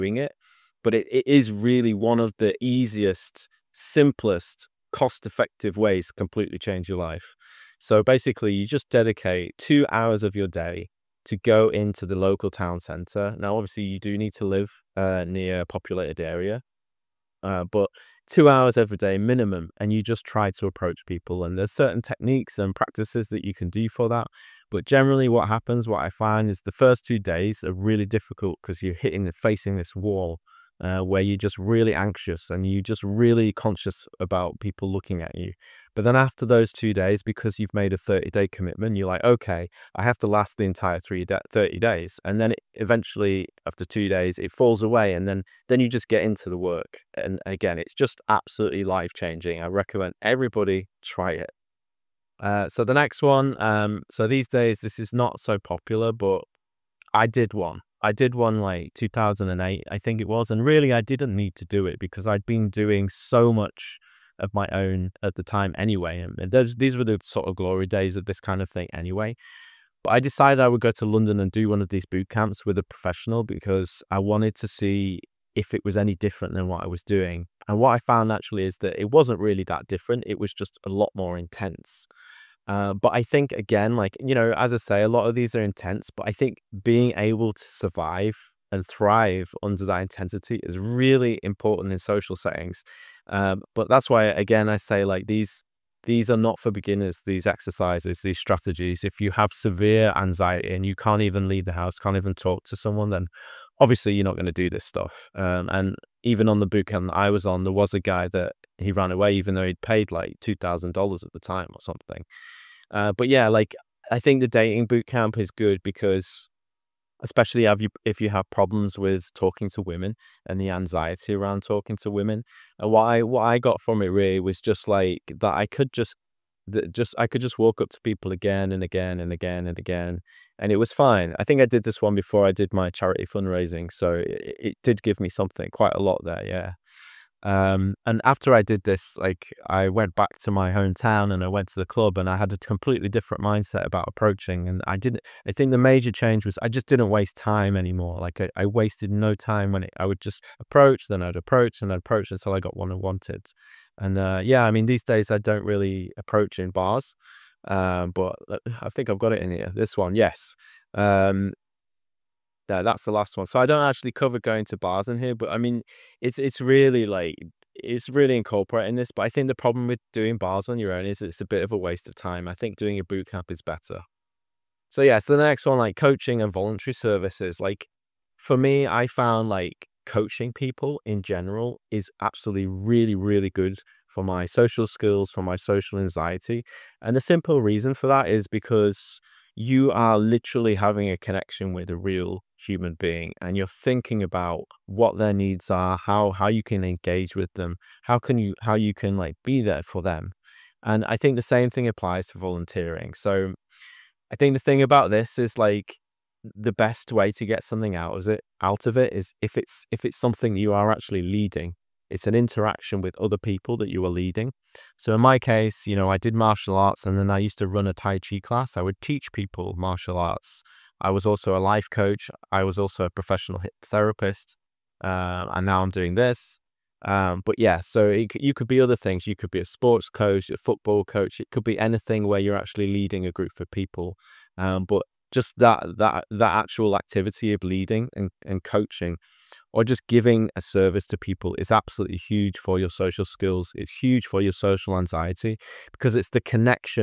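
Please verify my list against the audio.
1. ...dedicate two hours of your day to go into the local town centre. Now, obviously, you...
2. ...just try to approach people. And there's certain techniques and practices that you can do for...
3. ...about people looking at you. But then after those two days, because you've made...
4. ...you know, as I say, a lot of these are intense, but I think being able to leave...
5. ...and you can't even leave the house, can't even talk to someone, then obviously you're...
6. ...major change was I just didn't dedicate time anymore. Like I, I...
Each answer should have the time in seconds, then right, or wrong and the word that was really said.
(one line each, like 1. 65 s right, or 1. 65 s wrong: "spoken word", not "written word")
1. 8 s right
2. 20 s right
3. 34 s right
4. 84 s wrong: "survive", not "leave"
5. 100 s right
6. 145 s wrong: "waste", not "dedicate".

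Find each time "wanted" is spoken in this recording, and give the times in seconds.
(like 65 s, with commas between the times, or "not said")
74 s, 152 s.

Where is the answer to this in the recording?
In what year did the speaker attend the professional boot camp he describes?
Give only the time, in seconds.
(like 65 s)
58 s.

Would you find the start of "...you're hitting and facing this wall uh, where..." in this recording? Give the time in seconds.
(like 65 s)
28 s.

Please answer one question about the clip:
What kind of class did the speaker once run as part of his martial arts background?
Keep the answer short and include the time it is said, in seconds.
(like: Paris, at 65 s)
Tai chi, at 217 s.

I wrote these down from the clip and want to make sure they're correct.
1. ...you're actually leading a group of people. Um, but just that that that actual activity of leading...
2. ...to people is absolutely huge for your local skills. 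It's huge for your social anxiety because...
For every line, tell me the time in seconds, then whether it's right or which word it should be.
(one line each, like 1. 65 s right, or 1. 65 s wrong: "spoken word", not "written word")
1. 232 s right
2. 241 s wrong: "social", not "local".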